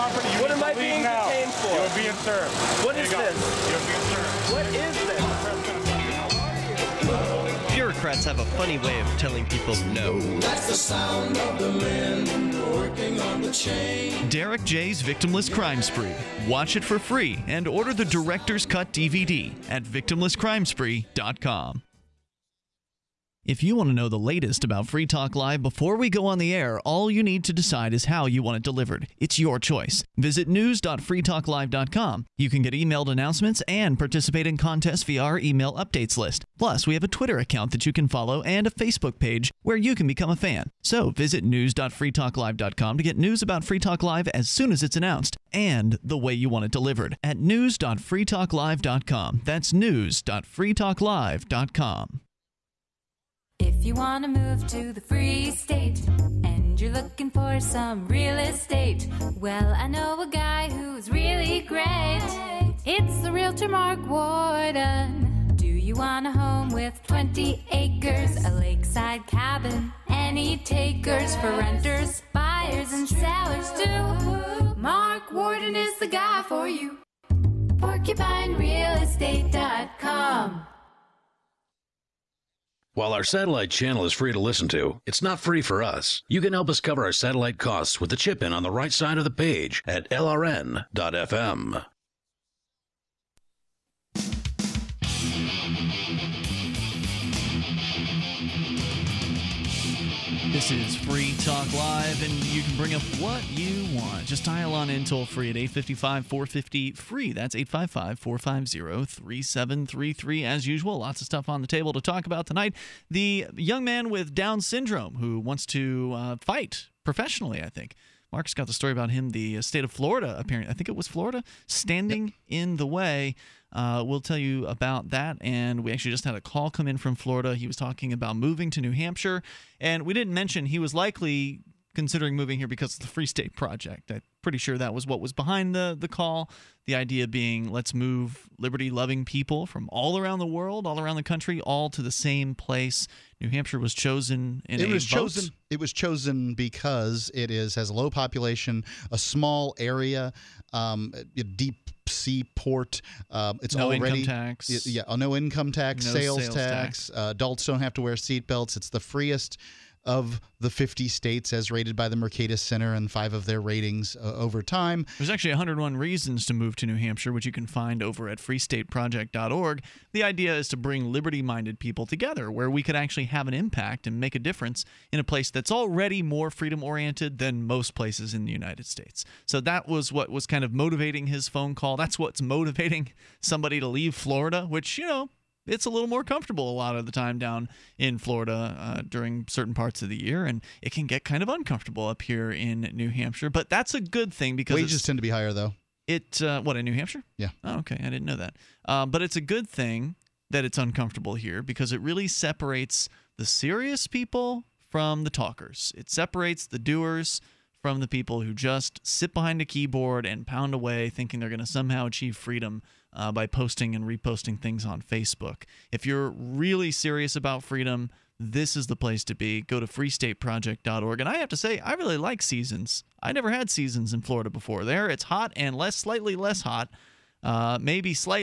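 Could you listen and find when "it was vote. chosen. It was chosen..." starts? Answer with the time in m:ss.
2:24.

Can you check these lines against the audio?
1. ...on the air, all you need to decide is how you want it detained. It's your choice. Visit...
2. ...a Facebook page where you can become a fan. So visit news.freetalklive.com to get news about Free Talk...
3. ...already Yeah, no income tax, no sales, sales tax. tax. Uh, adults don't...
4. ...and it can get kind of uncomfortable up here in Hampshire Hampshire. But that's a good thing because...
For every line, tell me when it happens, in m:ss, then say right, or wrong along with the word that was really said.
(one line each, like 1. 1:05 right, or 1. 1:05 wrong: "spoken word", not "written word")
1. 0:26 wrong: "delivered", not "detained"
2. 0:38 right
3. 2:33 right
4. 3:10 wrong: "New", not "Hampshire".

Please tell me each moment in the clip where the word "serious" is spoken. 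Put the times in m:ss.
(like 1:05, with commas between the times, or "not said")
3:23, 3:36.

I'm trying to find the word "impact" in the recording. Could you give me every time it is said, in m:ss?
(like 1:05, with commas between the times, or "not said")
2:53.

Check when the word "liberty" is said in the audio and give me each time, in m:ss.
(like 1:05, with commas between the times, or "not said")
2:18, 2:51.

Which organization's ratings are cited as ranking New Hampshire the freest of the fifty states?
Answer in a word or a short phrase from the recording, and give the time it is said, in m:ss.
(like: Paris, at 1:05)
Mercatus Center, at 2:42.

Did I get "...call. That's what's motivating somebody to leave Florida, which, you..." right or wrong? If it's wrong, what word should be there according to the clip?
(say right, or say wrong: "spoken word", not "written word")
right.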